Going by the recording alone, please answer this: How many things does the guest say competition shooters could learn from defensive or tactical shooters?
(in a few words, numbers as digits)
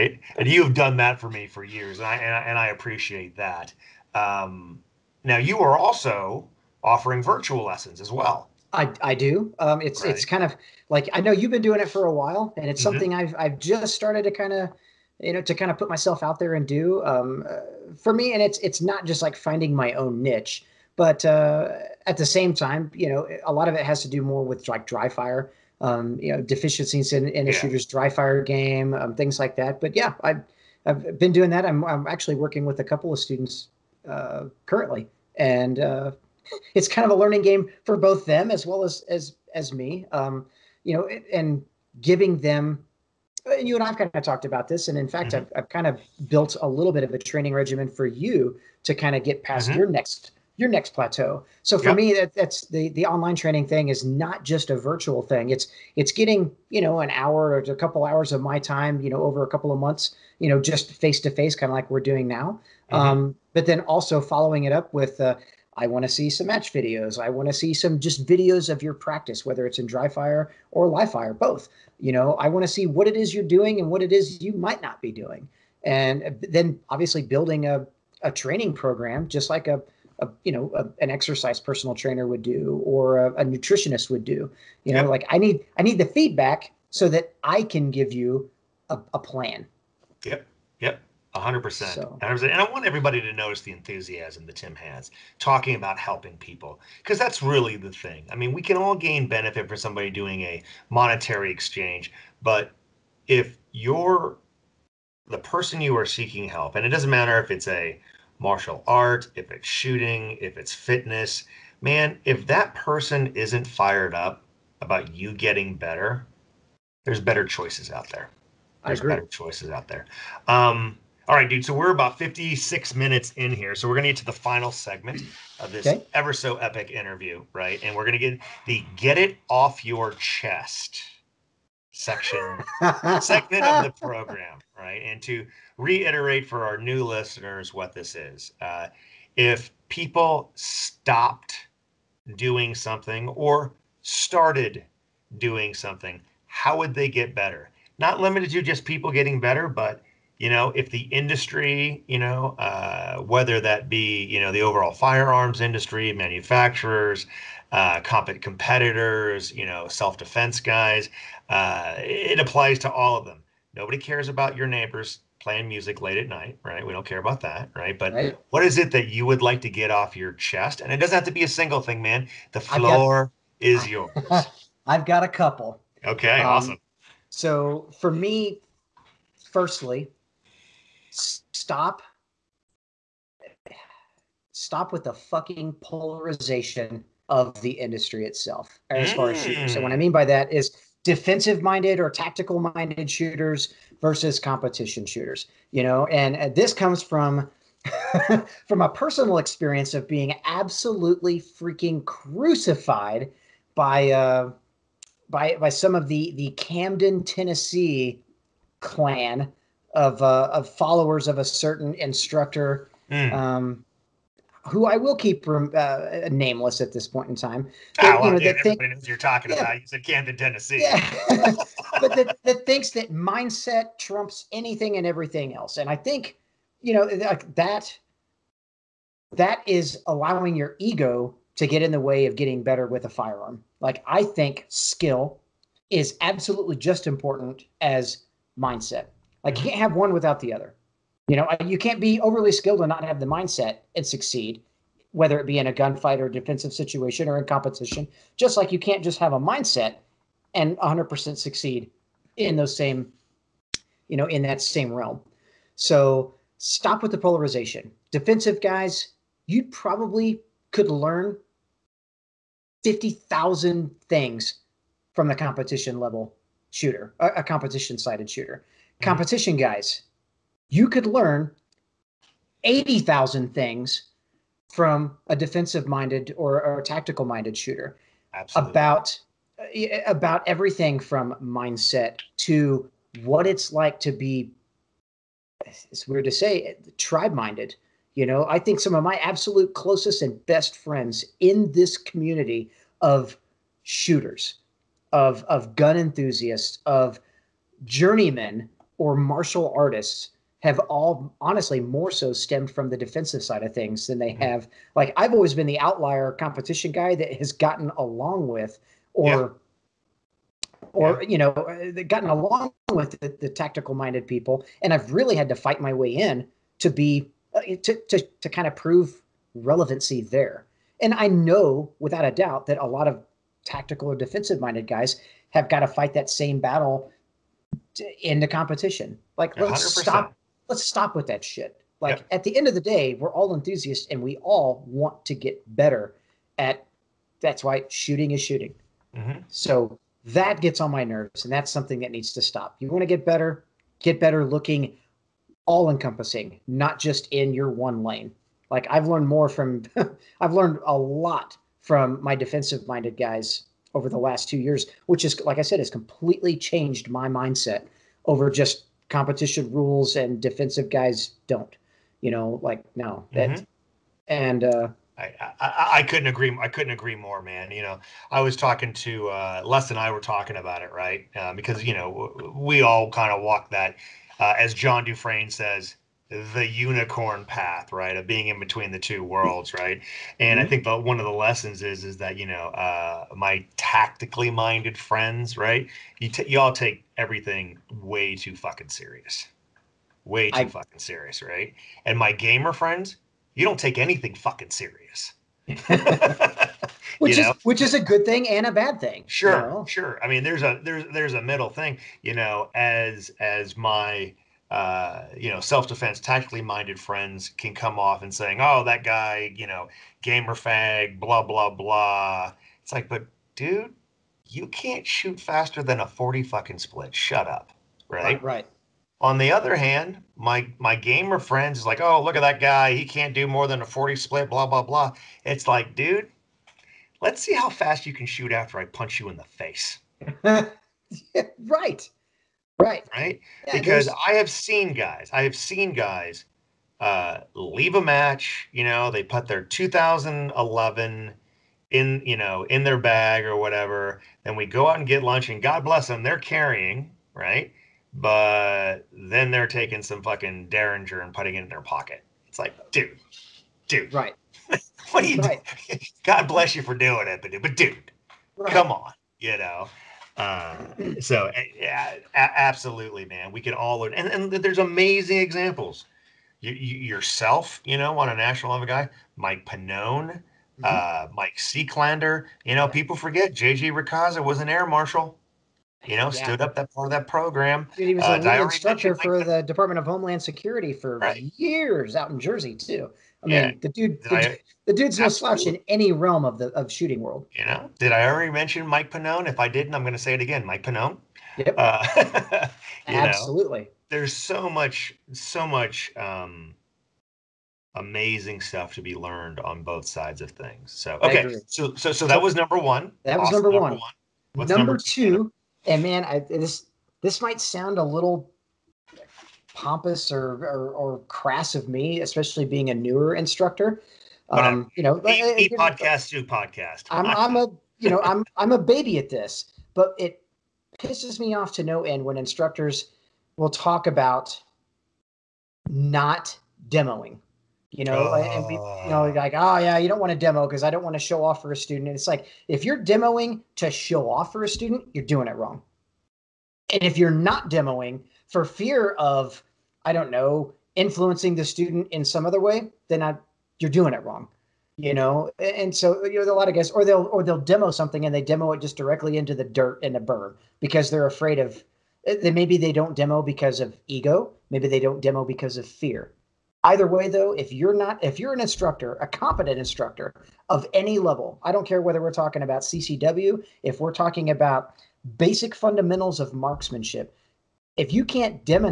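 80,000.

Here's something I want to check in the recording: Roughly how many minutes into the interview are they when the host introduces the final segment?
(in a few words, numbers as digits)
56.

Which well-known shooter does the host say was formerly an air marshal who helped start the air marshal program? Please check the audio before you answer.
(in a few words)
JJ Racaza.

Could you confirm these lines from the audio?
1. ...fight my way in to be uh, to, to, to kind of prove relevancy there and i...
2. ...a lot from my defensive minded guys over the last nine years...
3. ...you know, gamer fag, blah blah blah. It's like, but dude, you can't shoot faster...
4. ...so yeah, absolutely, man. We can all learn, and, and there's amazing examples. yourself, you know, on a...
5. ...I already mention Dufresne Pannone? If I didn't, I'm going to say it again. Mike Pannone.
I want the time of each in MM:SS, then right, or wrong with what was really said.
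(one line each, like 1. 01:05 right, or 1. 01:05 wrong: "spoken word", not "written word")
1. 05:15 right
2. 05:50 wrong: "two", not "nine"
3. 06:49 right
4. 07:41 right
5. 08:08 wrong: "Mike", not "Dufresne".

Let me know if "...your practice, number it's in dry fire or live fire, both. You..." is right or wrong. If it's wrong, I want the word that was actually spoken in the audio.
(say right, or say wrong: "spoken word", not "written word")
wrong: "whether", not "number".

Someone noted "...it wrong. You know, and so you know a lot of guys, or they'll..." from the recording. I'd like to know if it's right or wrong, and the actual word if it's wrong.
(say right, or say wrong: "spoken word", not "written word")
right.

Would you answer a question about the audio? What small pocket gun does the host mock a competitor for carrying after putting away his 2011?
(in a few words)
Derringer.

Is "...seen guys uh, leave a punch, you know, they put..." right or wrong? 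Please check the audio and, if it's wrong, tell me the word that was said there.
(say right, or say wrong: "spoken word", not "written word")
wrong: "match", not "punch".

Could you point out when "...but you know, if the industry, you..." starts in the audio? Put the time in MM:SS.
02:29.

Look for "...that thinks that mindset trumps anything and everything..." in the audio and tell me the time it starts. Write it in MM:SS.
03:42.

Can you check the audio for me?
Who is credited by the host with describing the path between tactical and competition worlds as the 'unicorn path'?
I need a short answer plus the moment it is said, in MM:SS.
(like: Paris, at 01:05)
John Dufresne, at 06:14.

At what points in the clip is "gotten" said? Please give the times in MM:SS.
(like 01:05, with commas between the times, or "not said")
05:07, 05:12.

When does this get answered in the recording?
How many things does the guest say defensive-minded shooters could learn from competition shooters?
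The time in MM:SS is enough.
04:22.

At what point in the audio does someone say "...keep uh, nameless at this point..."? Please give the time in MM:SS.
03:35.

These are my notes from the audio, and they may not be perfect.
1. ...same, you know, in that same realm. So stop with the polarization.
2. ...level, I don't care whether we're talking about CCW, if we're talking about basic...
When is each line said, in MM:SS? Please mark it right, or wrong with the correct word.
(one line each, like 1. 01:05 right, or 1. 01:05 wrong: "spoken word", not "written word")
1. 04:12 right
2. 09:21 right.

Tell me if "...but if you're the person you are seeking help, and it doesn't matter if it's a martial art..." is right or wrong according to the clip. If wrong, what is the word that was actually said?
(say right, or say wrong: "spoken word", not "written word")
right.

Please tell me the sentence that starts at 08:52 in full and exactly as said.
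And it's like, if you're demoing to show off for a student, you're doing it wrong.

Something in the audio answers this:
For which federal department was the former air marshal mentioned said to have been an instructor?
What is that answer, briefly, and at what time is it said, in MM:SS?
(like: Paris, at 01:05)
Department of Homeland Security, at 07:59.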